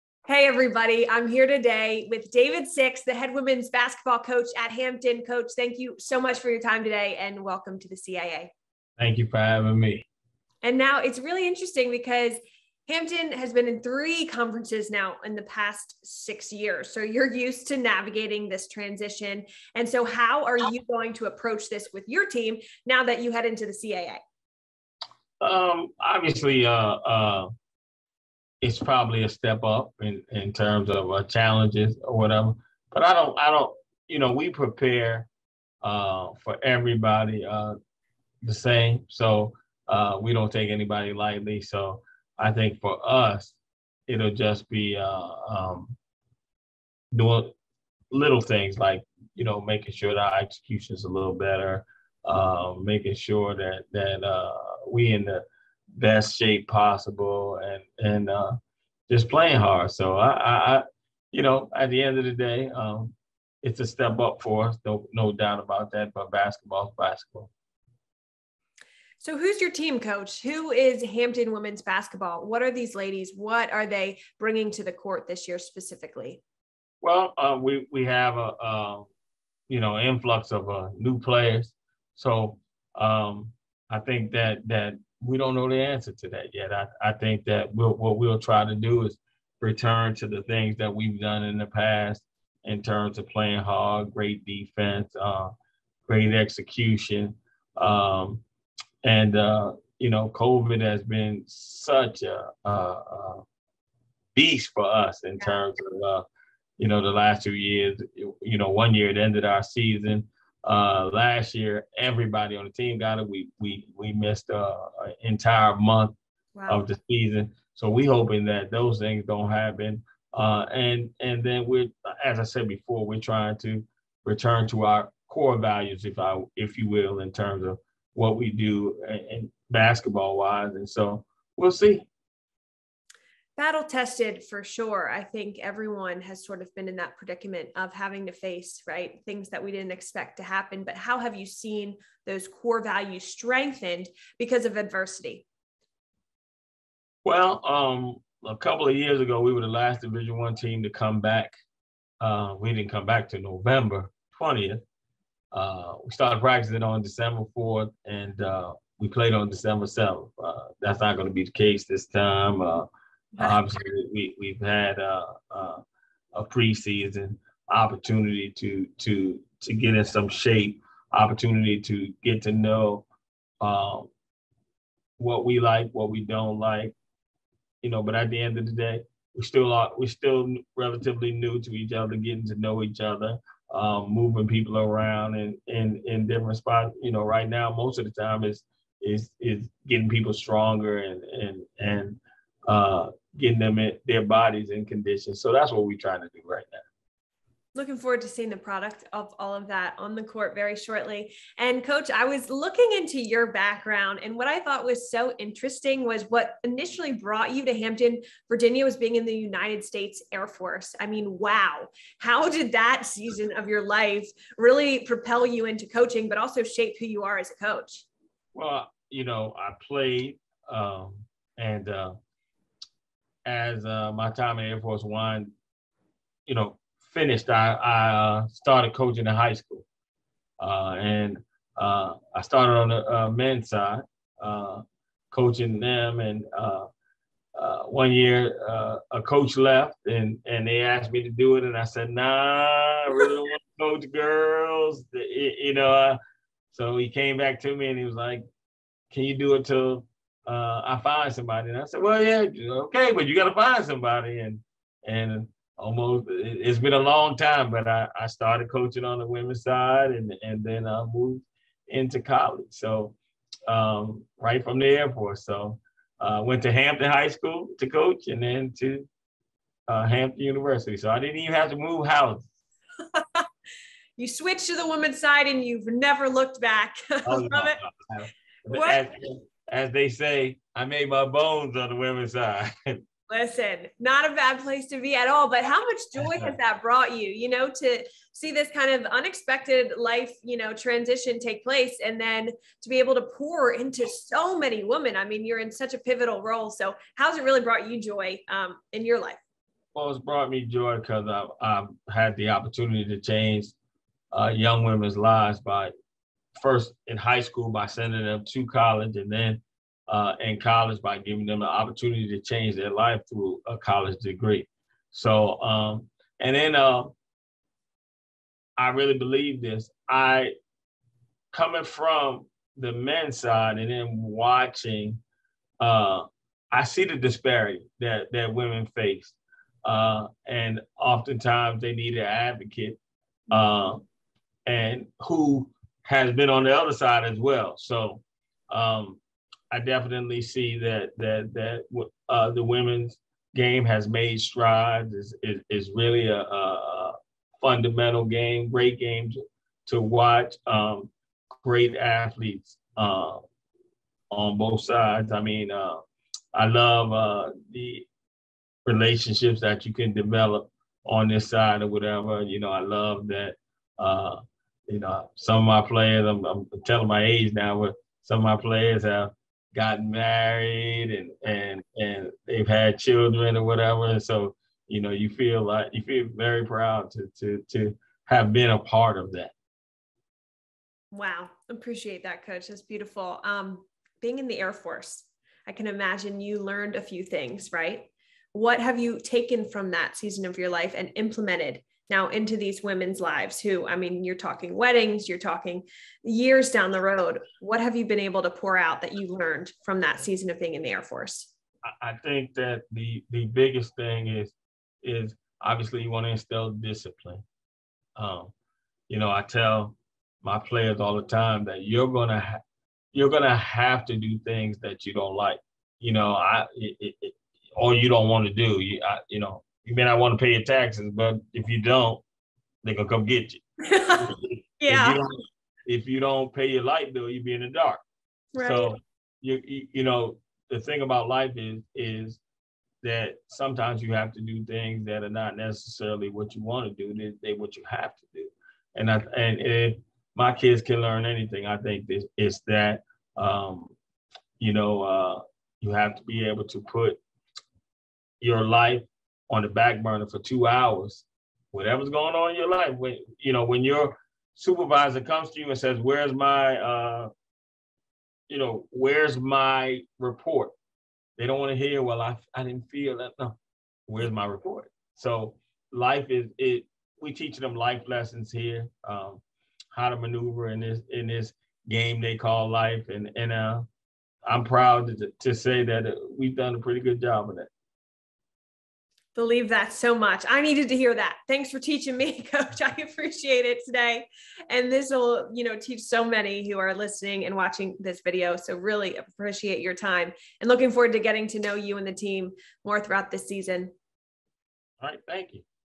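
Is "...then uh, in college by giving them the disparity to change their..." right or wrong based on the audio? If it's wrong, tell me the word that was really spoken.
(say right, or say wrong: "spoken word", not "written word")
wrong: "opportunity", not "disparity".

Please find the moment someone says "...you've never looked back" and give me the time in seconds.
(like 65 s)
275 s.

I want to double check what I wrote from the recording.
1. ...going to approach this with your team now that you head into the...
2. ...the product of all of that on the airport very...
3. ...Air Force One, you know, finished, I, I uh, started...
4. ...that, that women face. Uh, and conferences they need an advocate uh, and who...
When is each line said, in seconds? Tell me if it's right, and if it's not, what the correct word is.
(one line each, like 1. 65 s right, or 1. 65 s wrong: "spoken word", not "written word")
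1. 20 s right
2. 198 s wrong: "court", not "airport"
3. 224 s right
4. 327 s wrong: "oftentimes", not "conferences".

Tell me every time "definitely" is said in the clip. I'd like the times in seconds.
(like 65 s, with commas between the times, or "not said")
339 s.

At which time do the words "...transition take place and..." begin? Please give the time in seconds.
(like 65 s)
290 s.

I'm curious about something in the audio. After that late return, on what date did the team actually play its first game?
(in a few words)
December 7th.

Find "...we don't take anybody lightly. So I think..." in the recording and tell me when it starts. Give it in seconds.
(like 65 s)
40 s.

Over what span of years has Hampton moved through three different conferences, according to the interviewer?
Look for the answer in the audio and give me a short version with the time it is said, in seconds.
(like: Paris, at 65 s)
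6 years, at 16 s.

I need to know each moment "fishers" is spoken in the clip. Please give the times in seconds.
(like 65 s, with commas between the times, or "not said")
not said.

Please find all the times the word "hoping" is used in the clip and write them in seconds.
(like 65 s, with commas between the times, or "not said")
118 s.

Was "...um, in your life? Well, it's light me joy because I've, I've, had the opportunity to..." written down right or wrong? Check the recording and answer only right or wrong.
wrong.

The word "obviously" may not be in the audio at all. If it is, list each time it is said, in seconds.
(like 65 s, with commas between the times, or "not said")
25 s, 163 s, 405 s.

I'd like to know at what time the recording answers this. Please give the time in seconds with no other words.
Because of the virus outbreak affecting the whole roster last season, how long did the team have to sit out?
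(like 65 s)
115 s.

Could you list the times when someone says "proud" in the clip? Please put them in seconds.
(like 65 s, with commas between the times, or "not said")
376 s, 474 s.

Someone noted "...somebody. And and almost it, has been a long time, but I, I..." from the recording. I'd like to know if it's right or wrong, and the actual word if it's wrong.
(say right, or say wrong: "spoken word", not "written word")
right.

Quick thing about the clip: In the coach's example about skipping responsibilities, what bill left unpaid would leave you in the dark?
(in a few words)
light bill.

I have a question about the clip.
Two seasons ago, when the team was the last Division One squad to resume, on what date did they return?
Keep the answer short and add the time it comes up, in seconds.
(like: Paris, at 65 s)
November 20th, at 153 s.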